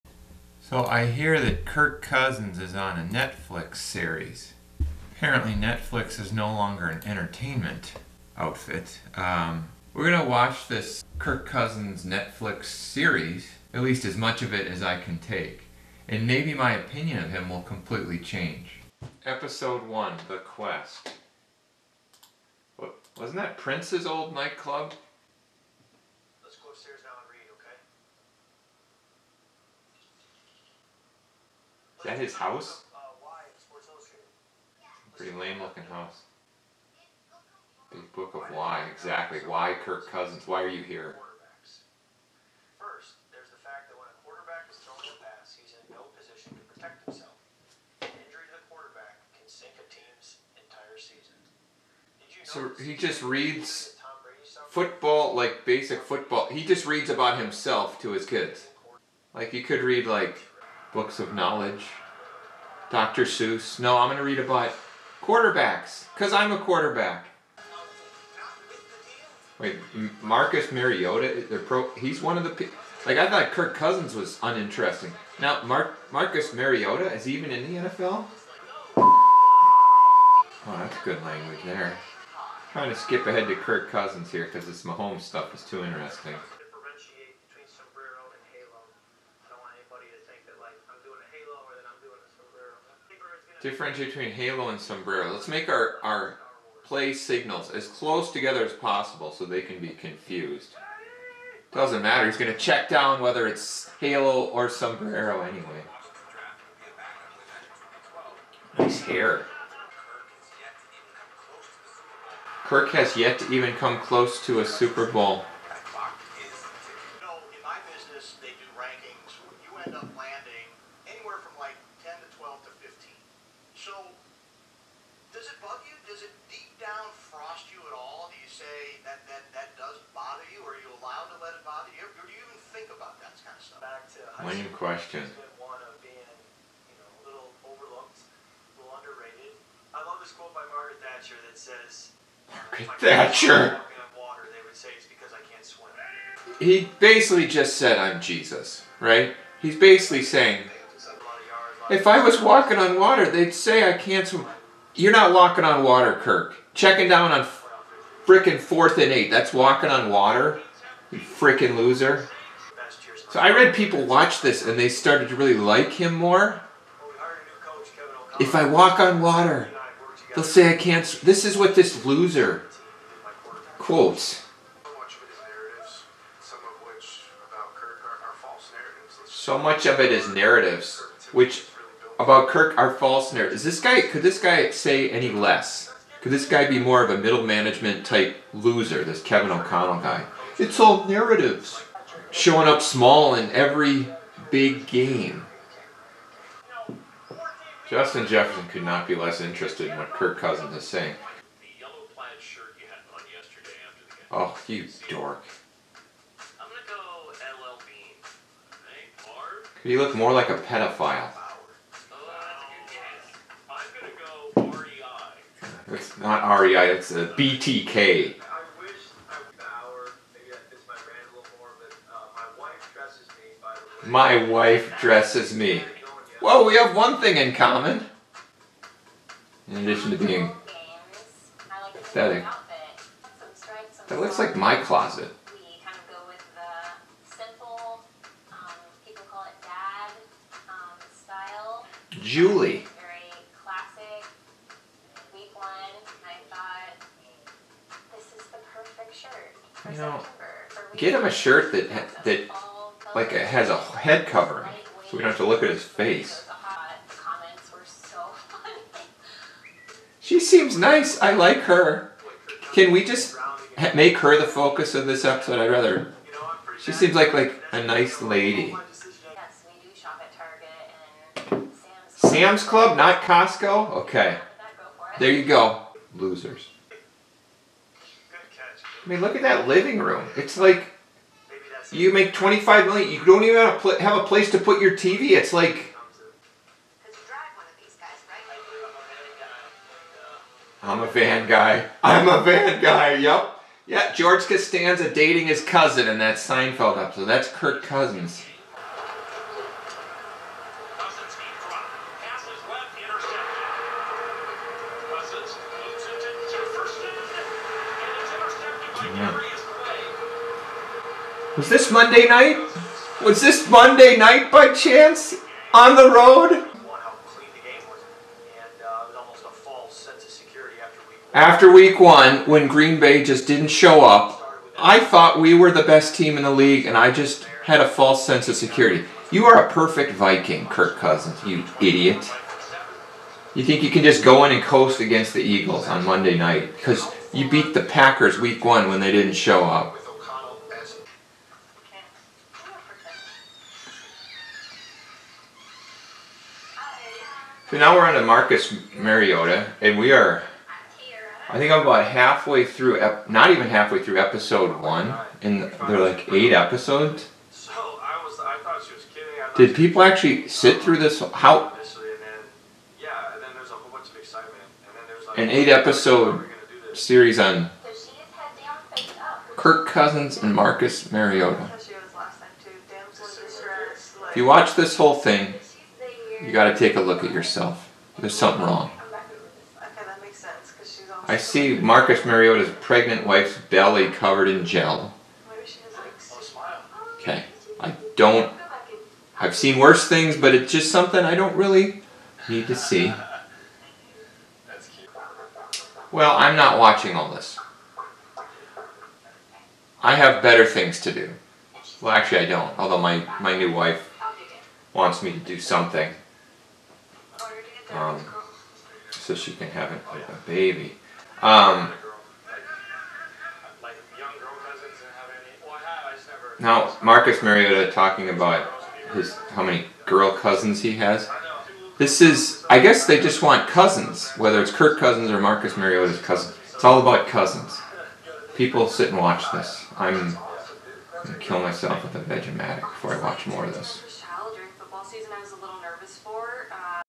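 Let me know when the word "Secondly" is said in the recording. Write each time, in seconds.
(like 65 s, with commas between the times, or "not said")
not said.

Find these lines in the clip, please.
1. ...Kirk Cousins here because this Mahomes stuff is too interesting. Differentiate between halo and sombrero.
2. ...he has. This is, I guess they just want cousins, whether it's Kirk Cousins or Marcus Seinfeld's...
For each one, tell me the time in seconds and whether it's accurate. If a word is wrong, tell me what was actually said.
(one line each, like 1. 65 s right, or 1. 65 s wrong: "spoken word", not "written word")
1. 83 s right
2. 420 s wrong: "Mariota", not "Seinfeld".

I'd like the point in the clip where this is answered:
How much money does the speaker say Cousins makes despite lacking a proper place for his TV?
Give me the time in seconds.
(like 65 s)
282 s.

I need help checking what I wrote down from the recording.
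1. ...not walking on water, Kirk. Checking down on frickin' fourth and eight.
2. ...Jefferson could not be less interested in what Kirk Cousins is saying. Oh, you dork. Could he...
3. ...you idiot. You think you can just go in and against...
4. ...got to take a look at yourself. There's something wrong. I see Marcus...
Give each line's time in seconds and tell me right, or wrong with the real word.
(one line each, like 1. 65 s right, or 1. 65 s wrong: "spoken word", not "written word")
1. 155 s right
2. 198 s right
3. 331 s wrong: "coast", not "against"
4. 376 s right.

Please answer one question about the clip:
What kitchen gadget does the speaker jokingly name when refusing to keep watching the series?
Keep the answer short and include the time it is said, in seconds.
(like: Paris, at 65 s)
Vegematic, at 432 s.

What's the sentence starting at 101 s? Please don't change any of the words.
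Doesn't matter, he's going to check down whether it's halo or sombrero anyway.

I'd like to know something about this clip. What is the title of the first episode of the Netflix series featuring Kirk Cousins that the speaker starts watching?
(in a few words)
The Quest.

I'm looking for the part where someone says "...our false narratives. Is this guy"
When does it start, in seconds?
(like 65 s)
182 s.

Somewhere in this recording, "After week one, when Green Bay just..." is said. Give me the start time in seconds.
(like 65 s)
321 s.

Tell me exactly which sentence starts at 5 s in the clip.
Apparently, Netflix is no longer an entertainment outfit.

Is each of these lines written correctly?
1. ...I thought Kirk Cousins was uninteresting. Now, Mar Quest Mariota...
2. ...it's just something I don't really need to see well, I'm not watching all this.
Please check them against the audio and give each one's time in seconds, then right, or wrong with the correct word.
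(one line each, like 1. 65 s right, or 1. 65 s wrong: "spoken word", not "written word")
1. 73 s wrong: "Marcus", not "Quest"
2. 390 s right.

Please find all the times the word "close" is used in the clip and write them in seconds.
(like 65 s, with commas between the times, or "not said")
97 s, 113 s.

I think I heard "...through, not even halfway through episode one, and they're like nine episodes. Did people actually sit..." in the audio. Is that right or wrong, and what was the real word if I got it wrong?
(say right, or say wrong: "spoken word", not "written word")
wrong: "eight", not "nine".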